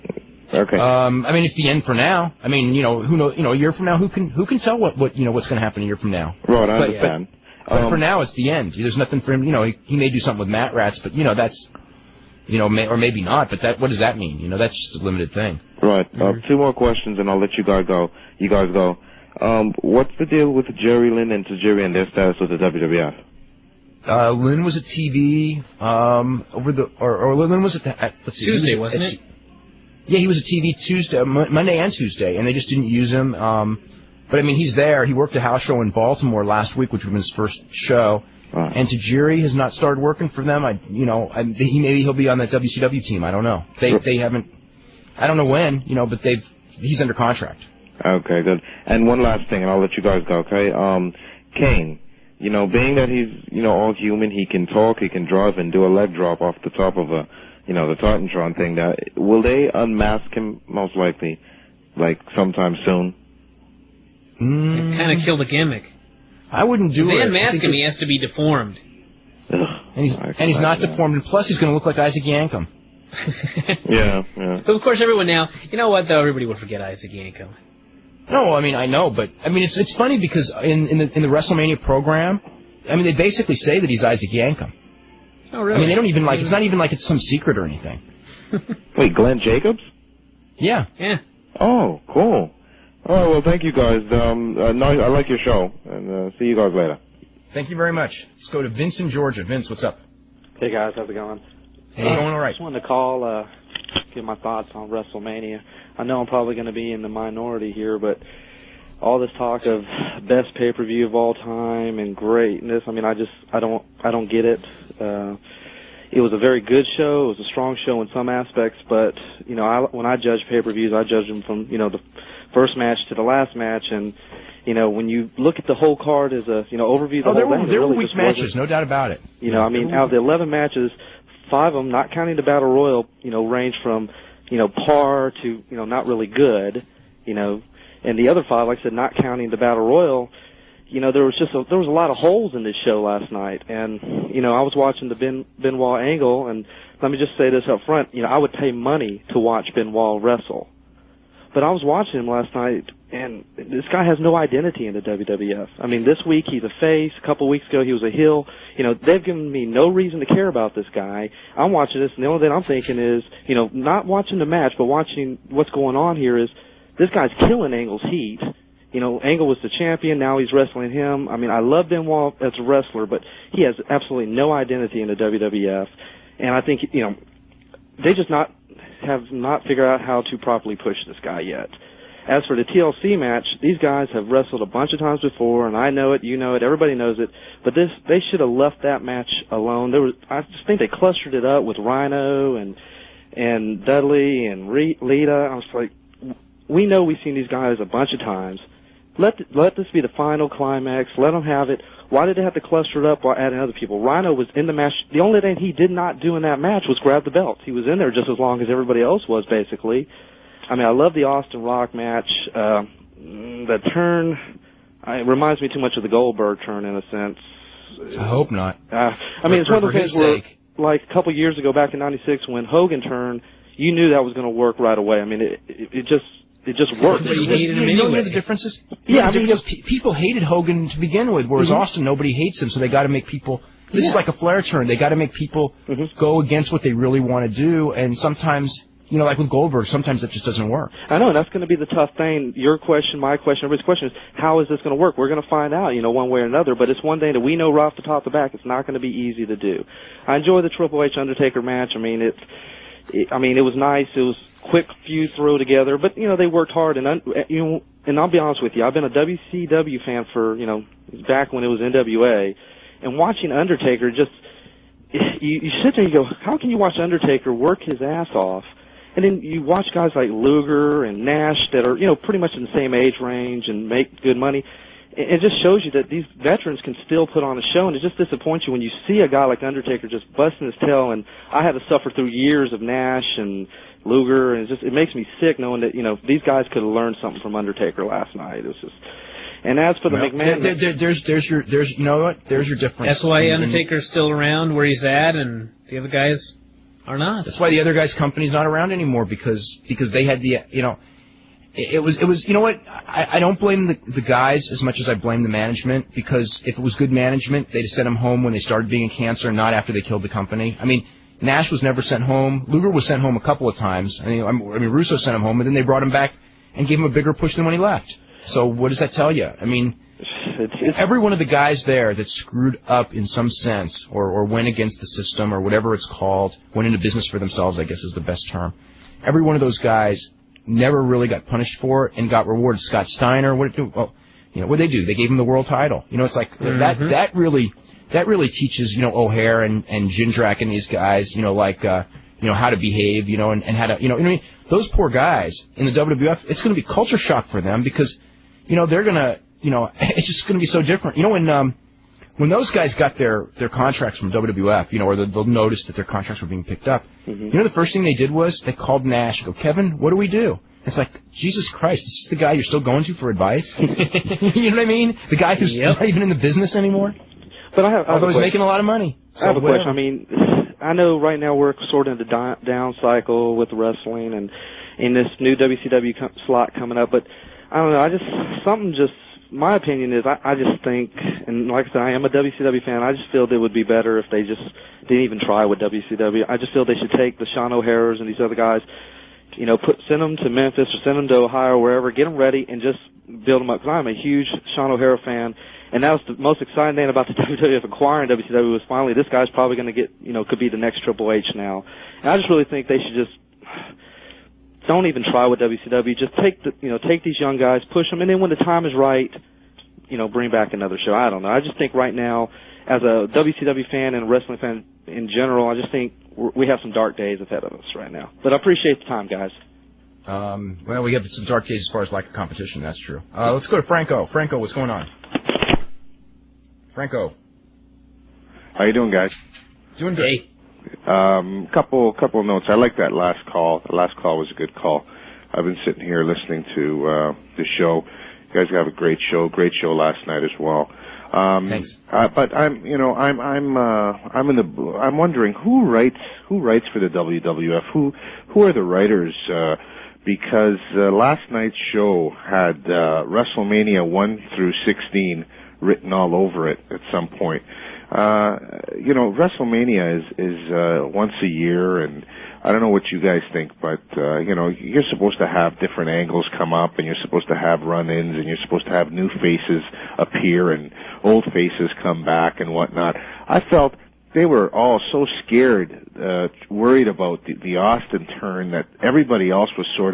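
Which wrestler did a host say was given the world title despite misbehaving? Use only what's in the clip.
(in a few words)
Scott Steiner.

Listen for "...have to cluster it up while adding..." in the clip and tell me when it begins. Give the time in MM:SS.
03:22.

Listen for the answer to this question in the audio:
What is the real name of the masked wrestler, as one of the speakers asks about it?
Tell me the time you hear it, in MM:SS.
01:29.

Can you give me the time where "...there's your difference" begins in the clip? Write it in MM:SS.
04:52.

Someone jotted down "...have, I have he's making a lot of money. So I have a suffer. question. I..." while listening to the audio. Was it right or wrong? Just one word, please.
wrong.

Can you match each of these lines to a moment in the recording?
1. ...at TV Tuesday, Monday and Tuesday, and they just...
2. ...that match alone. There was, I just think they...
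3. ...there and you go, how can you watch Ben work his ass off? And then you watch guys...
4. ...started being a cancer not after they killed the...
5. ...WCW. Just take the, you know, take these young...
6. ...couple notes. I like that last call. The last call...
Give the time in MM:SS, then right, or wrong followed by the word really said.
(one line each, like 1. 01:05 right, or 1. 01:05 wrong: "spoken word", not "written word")
1. 00:30 right
2. 03:08 right
3. 04:25 wrong: "Undertaker", not "Ben"
4. 05:08 right
5. 06:45 right
6. 07:12 right.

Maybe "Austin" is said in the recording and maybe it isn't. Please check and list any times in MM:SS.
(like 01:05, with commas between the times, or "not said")
03:31, 03:51, 07:57.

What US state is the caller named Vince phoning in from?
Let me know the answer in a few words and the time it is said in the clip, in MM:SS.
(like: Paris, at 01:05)
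Georgia, at 01:39.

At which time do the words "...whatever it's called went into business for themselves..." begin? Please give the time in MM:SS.
05:25.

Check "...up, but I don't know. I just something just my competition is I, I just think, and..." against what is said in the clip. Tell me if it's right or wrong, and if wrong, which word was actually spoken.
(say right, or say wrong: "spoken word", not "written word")
wrong: "opinion", not "competition".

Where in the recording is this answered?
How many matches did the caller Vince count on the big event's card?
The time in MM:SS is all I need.
02:10.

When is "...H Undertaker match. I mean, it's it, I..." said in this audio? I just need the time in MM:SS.
04:11.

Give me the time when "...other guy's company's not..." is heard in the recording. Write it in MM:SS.
04:57.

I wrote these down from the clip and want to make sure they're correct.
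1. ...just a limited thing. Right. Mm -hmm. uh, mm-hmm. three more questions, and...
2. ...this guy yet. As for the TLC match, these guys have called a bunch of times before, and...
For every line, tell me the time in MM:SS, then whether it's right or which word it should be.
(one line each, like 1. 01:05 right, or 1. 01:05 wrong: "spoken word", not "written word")
1. 00:14 wrong: "two", not "three"
2. 03:01 wrong: "wrestled", not "called".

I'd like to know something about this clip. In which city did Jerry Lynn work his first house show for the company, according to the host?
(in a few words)
Baltimore.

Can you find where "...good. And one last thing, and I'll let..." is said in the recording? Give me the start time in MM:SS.
00:48.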